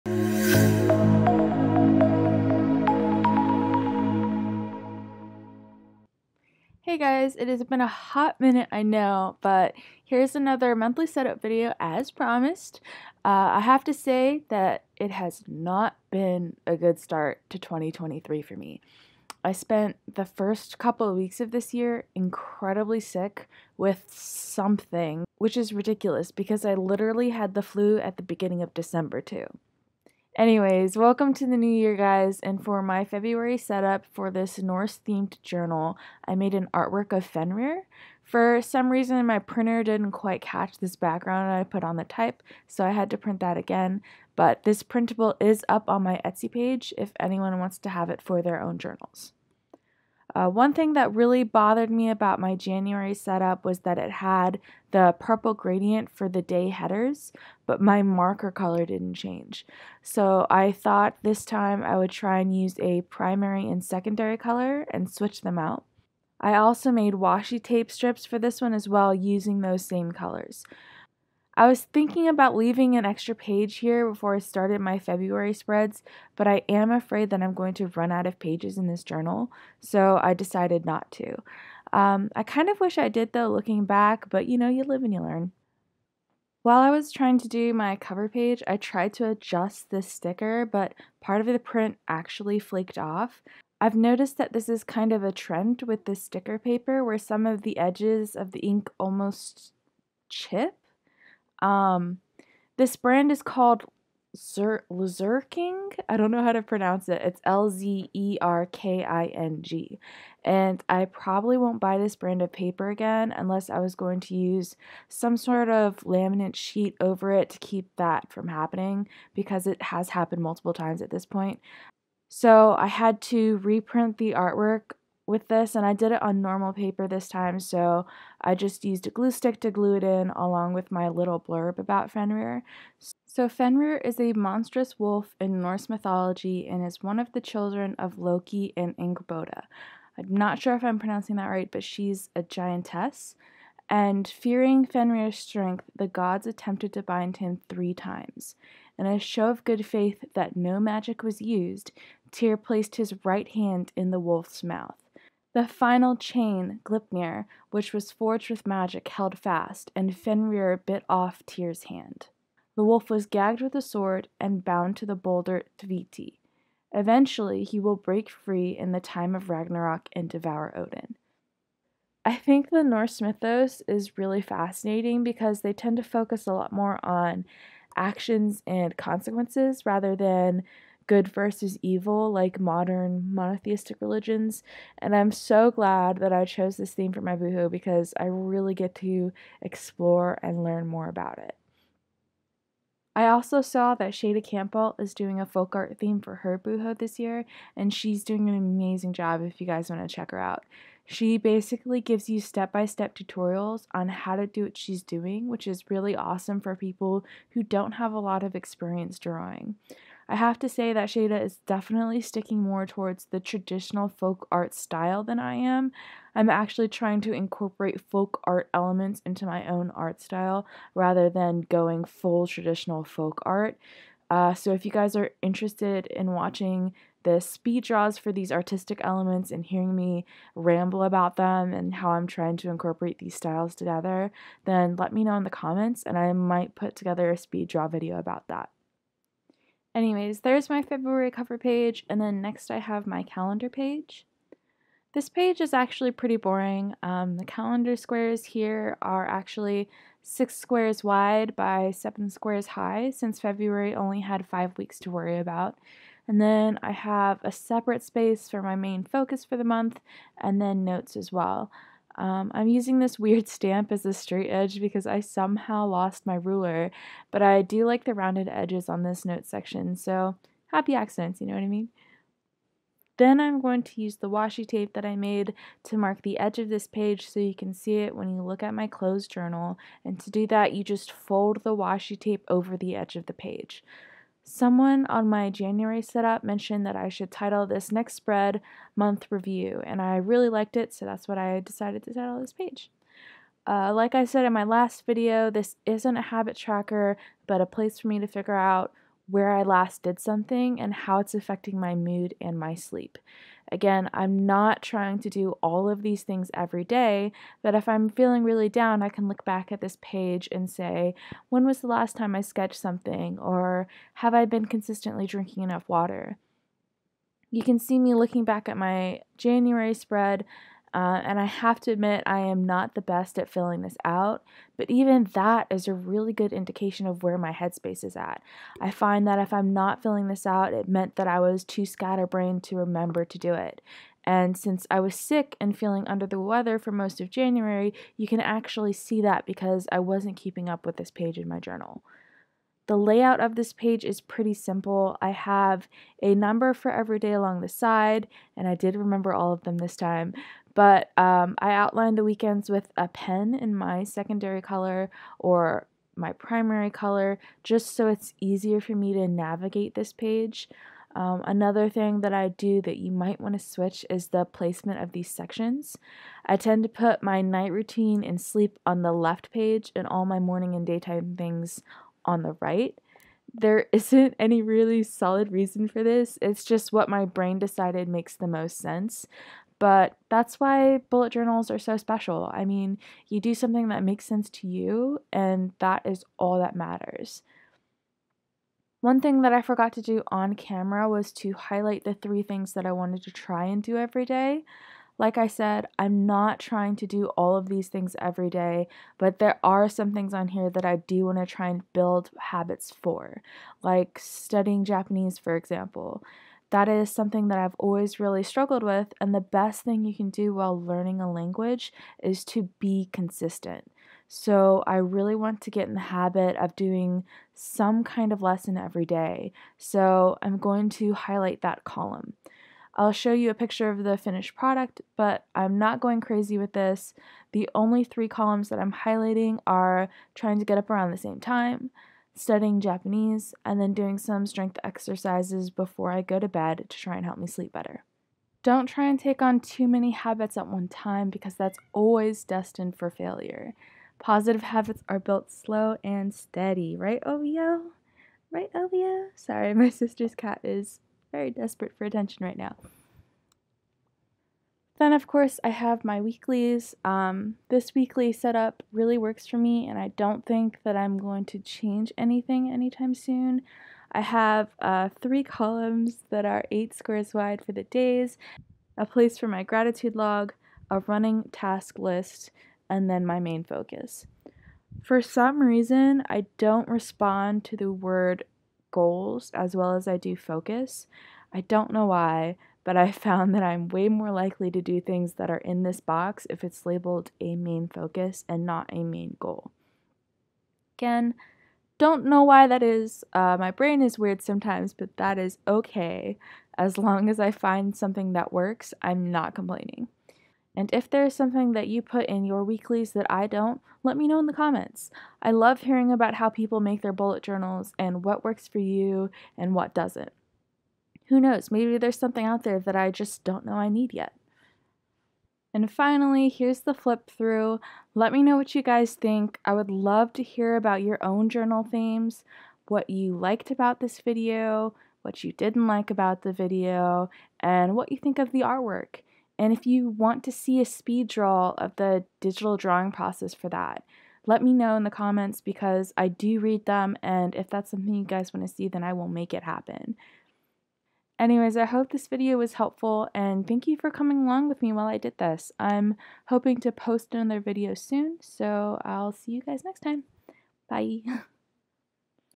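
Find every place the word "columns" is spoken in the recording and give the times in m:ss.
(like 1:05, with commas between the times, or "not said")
7:01, 7:08, 7:45.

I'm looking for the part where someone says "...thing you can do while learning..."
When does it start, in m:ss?
6:49.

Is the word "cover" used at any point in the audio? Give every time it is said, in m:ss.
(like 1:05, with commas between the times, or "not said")
1:27, 4:01.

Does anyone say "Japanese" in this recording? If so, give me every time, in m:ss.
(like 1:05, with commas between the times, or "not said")
6:44, 7:12.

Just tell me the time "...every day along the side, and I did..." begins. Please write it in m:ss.
5:46.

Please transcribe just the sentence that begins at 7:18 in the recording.
Don't try and take on too many habits at one time because that's always destined for failure.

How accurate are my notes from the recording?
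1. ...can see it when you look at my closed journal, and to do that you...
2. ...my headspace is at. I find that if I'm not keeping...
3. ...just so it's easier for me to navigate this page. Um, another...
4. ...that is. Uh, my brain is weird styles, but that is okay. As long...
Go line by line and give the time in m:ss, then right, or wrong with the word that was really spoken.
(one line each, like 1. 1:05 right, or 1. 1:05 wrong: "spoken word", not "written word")
1. 4:37 right
2. 5:27 wrong: "filling", not "keeping"
3. 5:57 right
4. 8:12 wrong: "sometimes", not "styles".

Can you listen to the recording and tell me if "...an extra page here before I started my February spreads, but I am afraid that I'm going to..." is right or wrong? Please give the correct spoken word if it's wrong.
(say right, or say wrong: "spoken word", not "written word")
right.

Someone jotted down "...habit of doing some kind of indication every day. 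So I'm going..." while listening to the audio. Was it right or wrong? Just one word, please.
wrong.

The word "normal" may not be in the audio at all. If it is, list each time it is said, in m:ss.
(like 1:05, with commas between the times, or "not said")
2:06.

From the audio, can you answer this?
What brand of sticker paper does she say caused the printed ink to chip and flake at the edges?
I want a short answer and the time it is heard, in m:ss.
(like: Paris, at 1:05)
Luzerking, at 1:44.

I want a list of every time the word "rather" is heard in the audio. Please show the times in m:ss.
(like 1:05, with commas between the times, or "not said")
2:59, 3:40.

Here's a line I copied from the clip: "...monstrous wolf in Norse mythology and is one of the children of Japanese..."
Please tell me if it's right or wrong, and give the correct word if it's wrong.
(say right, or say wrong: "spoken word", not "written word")
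wrong: "Loki", not "Japanese".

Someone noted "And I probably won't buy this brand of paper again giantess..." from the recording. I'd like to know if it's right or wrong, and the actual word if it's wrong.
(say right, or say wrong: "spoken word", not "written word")
wrong: "unless", not "giantess".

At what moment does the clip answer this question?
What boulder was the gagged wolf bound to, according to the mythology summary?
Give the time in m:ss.
2:45.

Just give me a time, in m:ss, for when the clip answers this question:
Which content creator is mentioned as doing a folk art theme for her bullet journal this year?
3:14.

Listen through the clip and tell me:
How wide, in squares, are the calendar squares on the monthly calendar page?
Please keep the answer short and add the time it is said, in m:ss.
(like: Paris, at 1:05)
6, at 4:10.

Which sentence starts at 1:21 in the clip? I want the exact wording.
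Um, I kind of wish I did though, looking back, but you know, you live and you learn.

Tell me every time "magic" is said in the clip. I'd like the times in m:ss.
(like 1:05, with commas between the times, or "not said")
2:30, 2:38.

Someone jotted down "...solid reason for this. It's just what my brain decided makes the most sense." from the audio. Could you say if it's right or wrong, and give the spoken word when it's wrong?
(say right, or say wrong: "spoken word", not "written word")
right.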